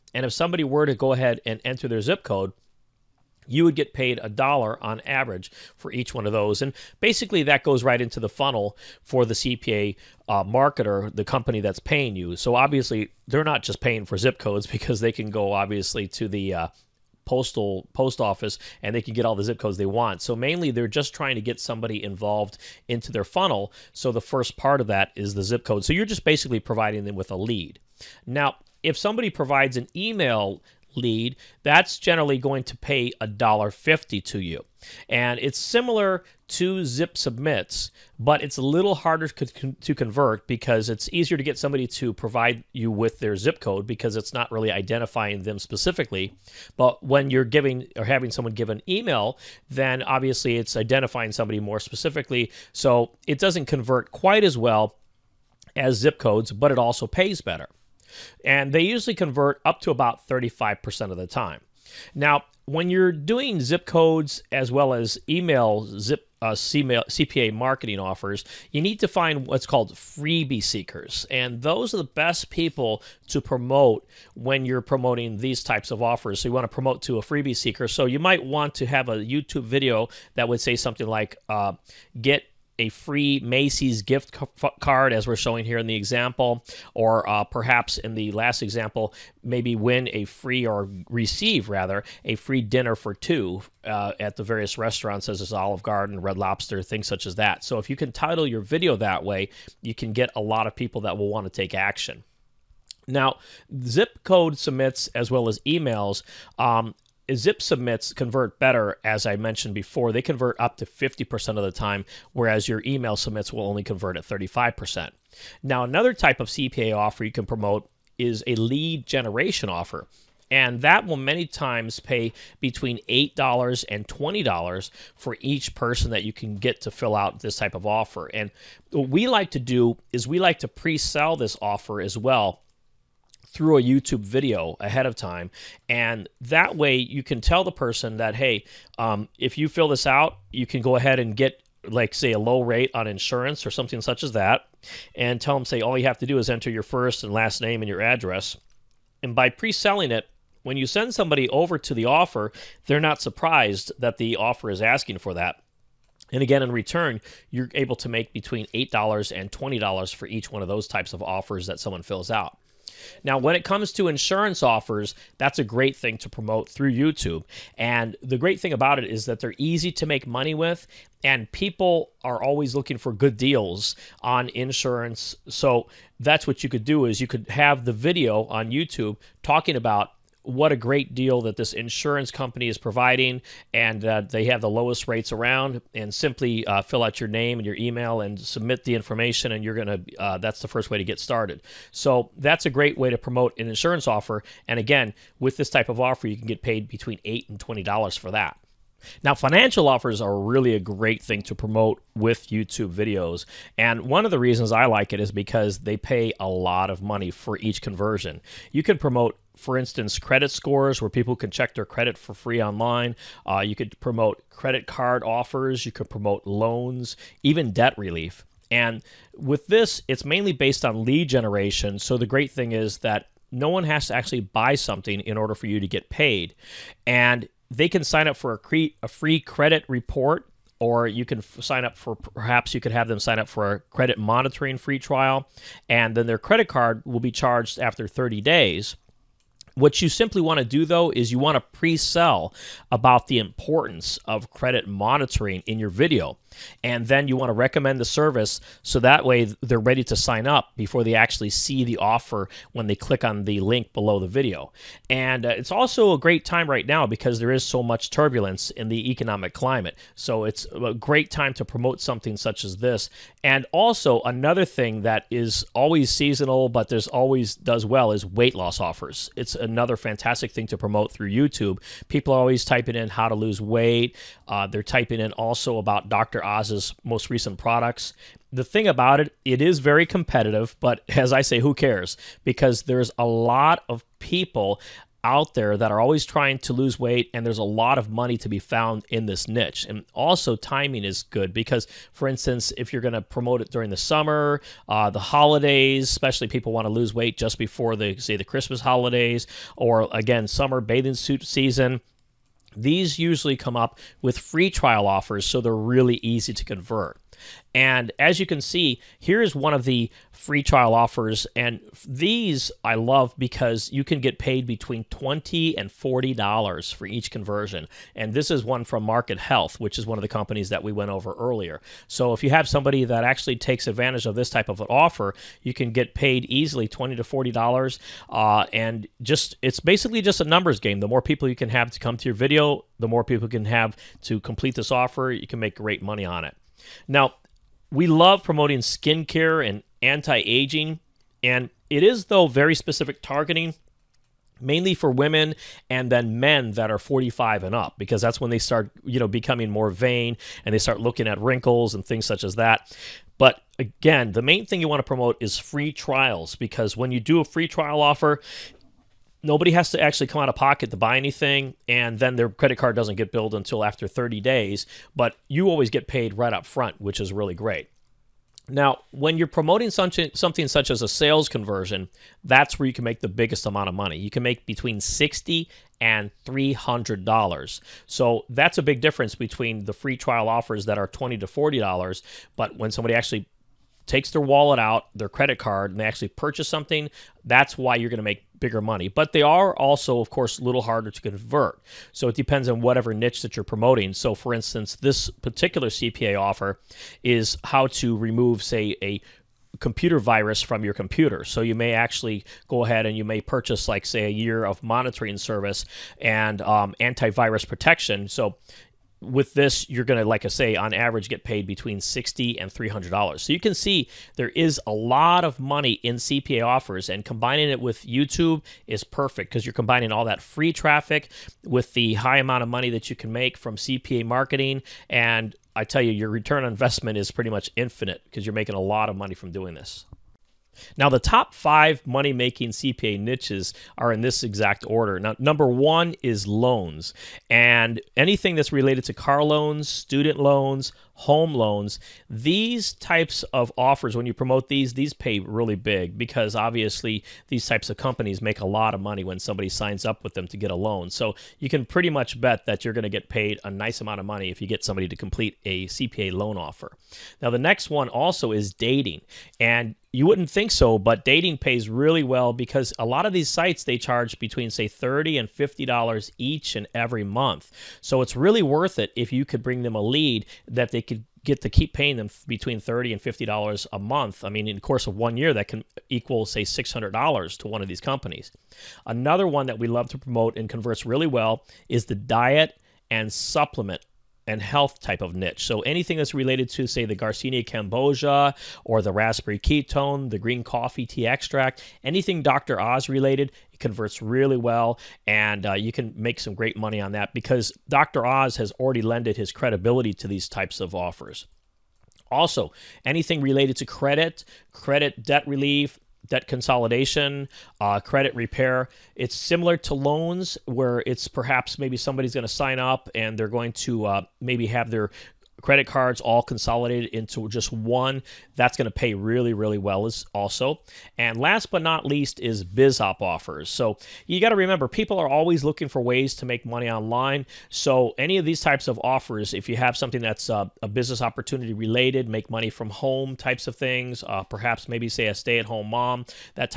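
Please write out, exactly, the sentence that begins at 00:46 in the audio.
But when you're giving or having someone give an email, then obviously it's identifying somebody more specifically.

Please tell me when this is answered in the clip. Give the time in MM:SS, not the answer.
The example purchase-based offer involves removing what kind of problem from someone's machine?
06:39.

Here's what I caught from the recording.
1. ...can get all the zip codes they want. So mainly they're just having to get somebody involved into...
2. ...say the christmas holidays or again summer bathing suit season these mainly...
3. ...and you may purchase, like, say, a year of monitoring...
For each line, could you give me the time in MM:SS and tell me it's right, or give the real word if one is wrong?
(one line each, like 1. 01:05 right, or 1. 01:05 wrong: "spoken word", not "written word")
1. 00:19 wrong: "trying", not "having"
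2. 04:58 wrong: "usually", not "mainly"
3. 06:43 right.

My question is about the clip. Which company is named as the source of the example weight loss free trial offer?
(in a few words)
Market Health.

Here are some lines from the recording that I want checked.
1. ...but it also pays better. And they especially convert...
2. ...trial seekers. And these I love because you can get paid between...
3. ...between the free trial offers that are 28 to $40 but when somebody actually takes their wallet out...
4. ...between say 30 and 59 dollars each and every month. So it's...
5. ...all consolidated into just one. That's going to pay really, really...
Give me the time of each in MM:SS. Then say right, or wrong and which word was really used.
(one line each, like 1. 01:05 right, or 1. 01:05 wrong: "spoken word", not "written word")
1. 00:56 wrong: "usually", not "especially"
2. 05:10 wrong: "offers", not "seekers"
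3. 06:19 wrong: "20", not "28"
4. 07:44 wrong: "50", not "59"
5. 08:36 right.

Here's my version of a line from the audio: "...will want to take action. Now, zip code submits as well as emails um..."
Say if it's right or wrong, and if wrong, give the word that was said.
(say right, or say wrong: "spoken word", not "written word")
right.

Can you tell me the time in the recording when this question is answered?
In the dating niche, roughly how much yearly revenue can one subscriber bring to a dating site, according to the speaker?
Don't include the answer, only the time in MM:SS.
07:56.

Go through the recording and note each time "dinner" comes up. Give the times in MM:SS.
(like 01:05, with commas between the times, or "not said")
01:32.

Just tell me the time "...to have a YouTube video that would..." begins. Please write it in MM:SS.
01:18.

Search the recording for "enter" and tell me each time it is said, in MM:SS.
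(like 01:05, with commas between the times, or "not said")
00:01, 02:26.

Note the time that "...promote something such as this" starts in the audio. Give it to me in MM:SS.
04:21.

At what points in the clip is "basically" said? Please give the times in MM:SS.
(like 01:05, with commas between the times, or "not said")
00:07, 00:26, 05:29.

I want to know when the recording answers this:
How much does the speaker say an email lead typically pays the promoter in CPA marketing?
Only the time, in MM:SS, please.
00:33.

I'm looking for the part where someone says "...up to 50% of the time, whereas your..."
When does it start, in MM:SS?
01:50.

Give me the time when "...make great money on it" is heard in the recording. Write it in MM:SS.
05:35.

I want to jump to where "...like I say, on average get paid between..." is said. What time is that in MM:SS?
06:50.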